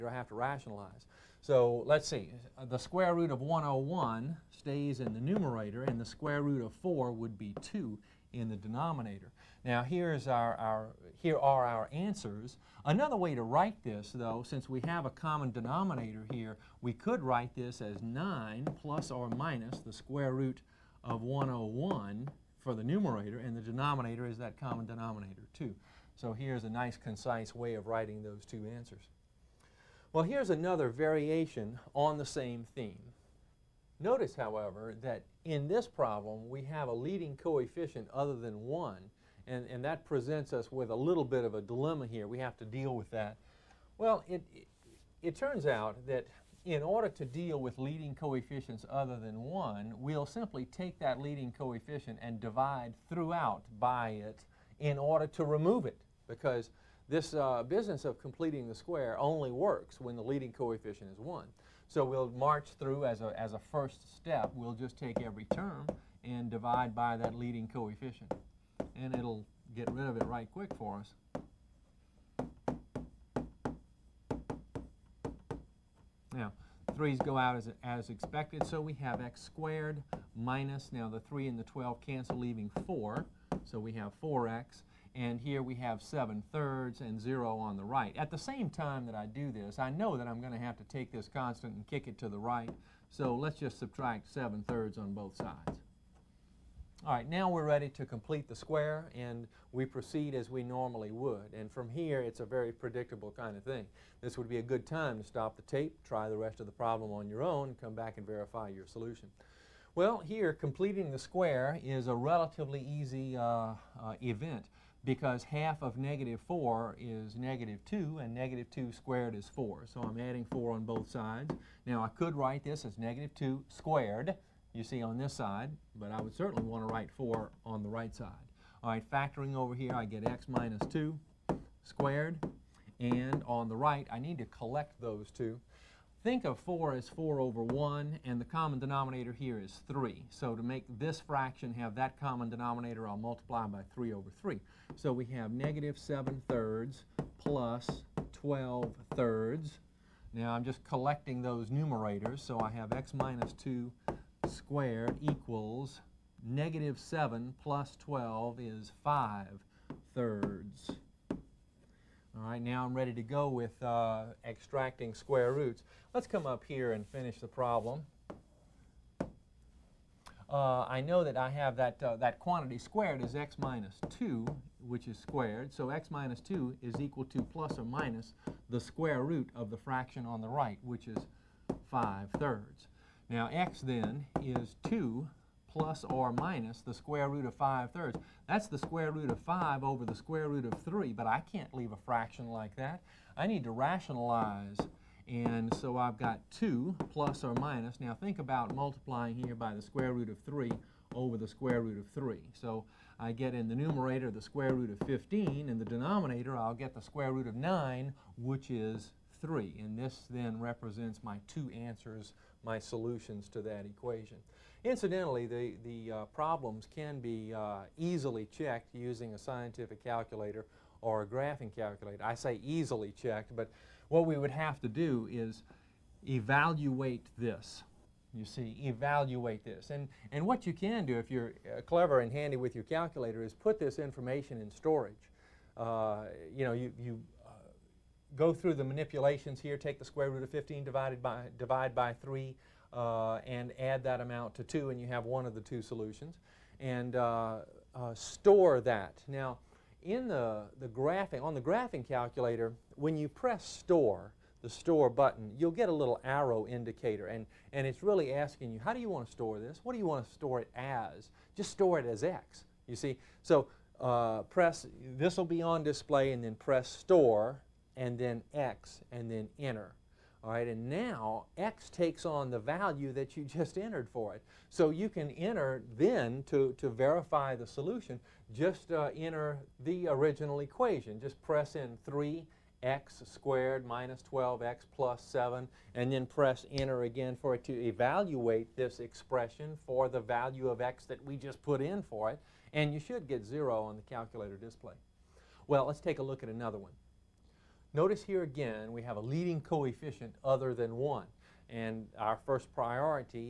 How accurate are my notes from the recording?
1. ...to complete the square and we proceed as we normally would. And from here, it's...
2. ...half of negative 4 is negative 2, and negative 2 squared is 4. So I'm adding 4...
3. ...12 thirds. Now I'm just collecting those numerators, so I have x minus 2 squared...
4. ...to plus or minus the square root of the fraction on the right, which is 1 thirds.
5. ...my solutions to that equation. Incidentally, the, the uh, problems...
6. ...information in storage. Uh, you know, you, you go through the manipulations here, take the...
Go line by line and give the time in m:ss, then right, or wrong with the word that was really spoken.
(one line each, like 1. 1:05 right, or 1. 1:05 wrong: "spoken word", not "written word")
1. 1:37 right
2. 1:55 right
3. 2:28 right
4. 2:57 wrong: "5", not "1"
5. 3:32 right
6. 3:53 right.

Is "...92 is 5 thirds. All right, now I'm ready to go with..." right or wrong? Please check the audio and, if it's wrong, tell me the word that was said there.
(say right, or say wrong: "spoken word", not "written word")
wrong: "12", not "92".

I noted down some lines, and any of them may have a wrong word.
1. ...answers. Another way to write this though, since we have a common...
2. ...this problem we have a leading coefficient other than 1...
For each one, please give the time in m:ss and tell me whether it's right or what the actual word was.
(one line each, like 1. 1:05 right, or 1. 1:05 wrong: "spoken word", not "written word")
1. 0:11 right
2. 0:35 right.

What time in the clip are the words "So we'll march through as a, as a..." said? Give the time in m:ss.
1:01.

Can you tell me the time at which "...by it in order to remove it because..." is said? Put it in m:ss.
0:53.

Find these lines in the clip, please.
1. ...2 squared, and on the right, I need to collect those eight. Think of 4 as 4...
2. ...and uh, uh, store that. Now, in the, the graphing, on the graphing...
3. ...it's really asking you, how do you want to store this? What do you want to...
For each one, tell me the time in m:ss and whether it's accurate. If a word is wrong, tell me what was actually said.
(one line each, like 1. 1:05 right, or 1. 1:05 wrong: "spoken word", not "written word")
1. 2:10 wrong: "two", not "eight"
2. 4:06 right
3. 4:17 right.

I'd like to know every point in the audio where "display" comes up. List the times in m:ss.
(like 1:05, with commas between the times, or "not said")
4:25, 4:54.